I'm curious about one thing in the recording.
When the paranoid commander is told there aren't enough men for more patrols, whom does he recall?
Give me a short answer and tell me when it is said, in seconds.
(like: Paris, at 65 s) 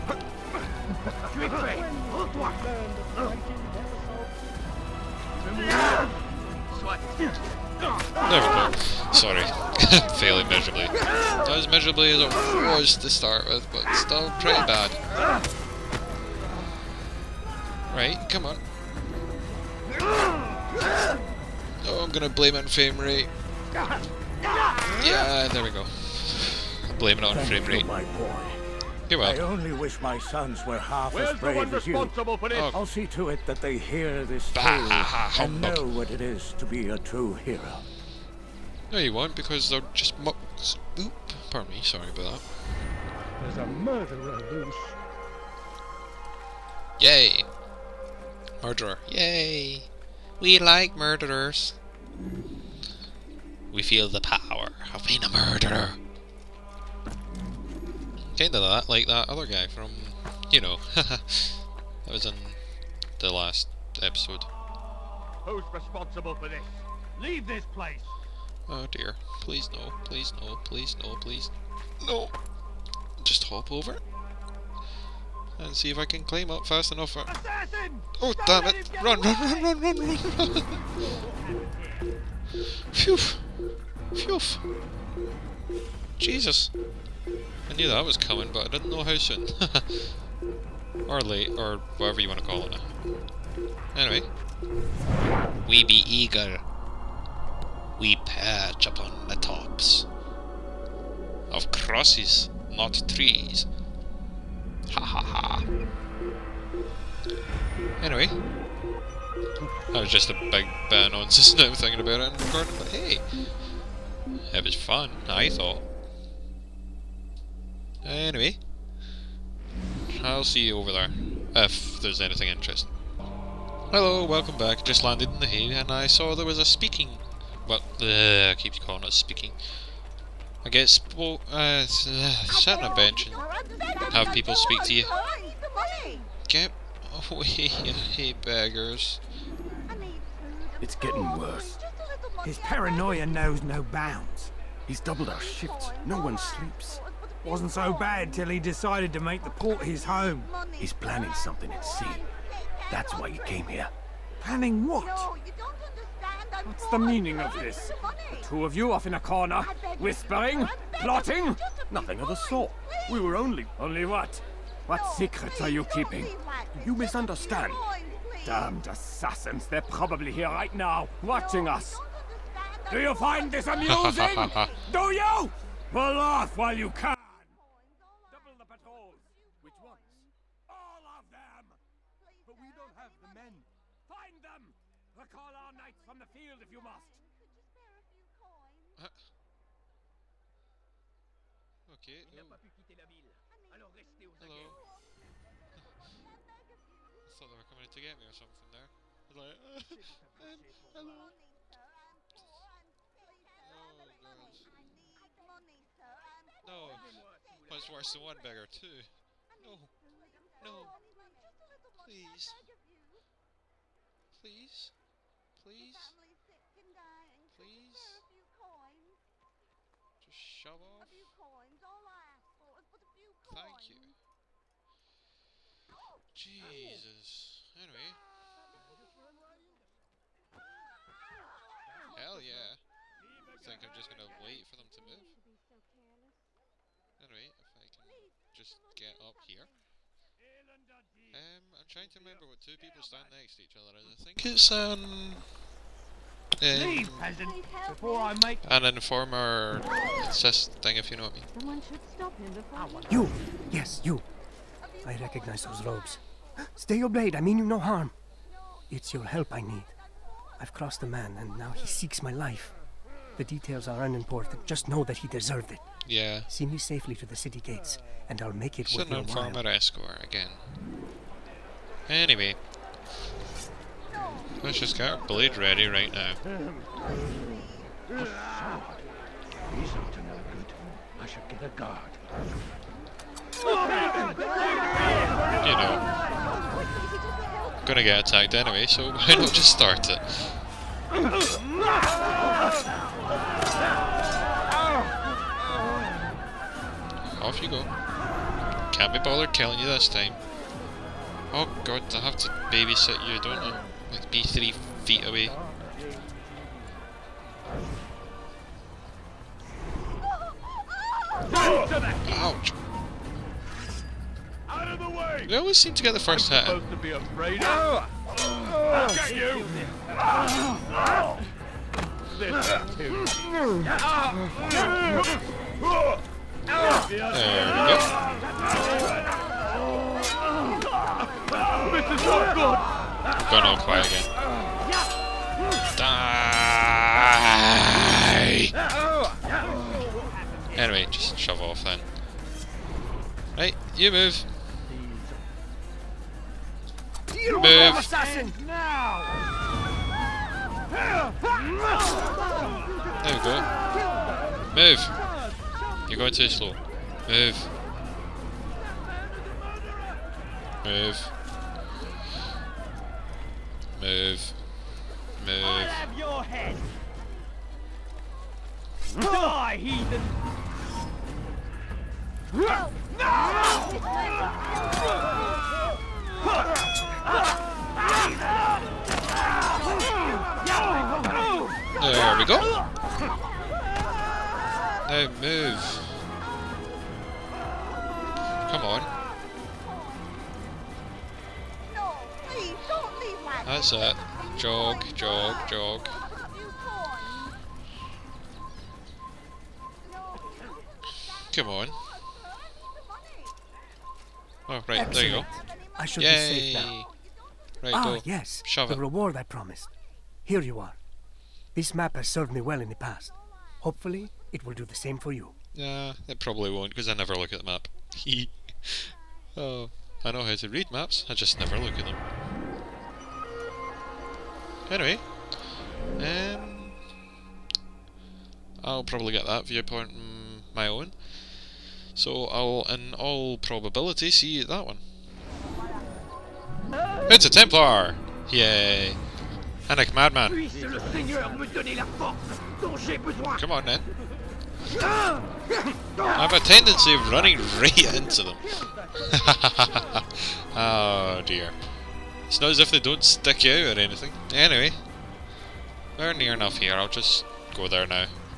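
Our knights, at 185 s.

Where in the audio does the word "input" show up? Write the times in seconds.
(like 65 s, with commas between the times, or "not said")
not said.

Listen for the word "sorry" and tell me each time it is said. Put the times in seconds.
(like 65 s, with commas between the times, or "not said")
9 s, 41 s.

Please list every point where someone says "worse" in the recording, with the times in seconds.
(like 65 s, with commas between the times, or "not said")
141 s, 207 s.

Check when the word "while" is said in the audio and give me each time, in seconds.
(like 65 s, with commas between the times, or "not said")
176 s, 269 s.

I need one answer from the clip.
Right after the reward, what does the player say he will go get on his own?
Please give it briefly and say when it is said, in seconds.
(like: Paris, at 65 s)
That viewpoint, at 429 s.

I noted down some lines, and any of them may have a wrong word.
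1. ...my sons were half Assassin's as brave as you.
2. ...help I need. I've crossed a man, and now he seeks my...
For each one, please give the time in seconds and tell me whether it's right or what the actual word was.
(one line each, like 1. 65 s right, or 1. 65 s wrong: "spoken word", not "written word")
1. 30 s wrong: "Where", not "Assassin"
2. 259 s right.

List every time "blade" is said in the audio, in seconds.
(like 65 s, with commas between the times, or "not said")
257 s, 275 s.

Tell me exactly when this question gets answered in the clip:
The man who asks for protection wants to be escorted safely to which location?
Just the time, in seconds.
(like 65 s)
267 s.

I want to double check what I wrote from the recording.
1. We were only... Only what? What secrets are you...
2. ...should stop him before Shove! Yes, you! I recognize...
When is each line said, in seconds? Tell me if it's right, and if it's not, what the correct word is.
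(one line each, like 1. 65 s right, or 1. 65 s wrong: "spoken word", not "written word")
1. 163 s right
2. 251 s wrong: "You", not "Shove".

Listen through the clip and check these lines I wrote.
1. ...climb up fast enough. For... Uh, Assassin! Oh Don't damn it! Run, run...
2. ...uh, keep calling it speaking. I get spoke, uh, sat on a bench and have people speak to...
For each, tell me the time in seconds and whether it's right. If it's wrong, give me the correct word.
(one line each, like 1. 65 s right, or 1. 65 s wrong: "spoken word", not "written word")
1. 76 s right
2. 128 s right.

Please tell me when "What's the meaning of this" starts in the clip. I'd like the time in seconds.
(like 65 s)
156 s.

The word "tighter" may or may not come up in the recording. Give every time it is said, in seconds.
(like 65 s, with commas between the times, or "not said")
not said.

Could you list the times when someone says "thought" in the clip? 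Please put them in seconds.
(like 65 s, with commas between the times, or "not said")
115 s, 194 s.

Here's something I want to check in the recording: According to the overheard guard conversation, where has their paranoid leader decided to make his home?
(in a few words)
The port.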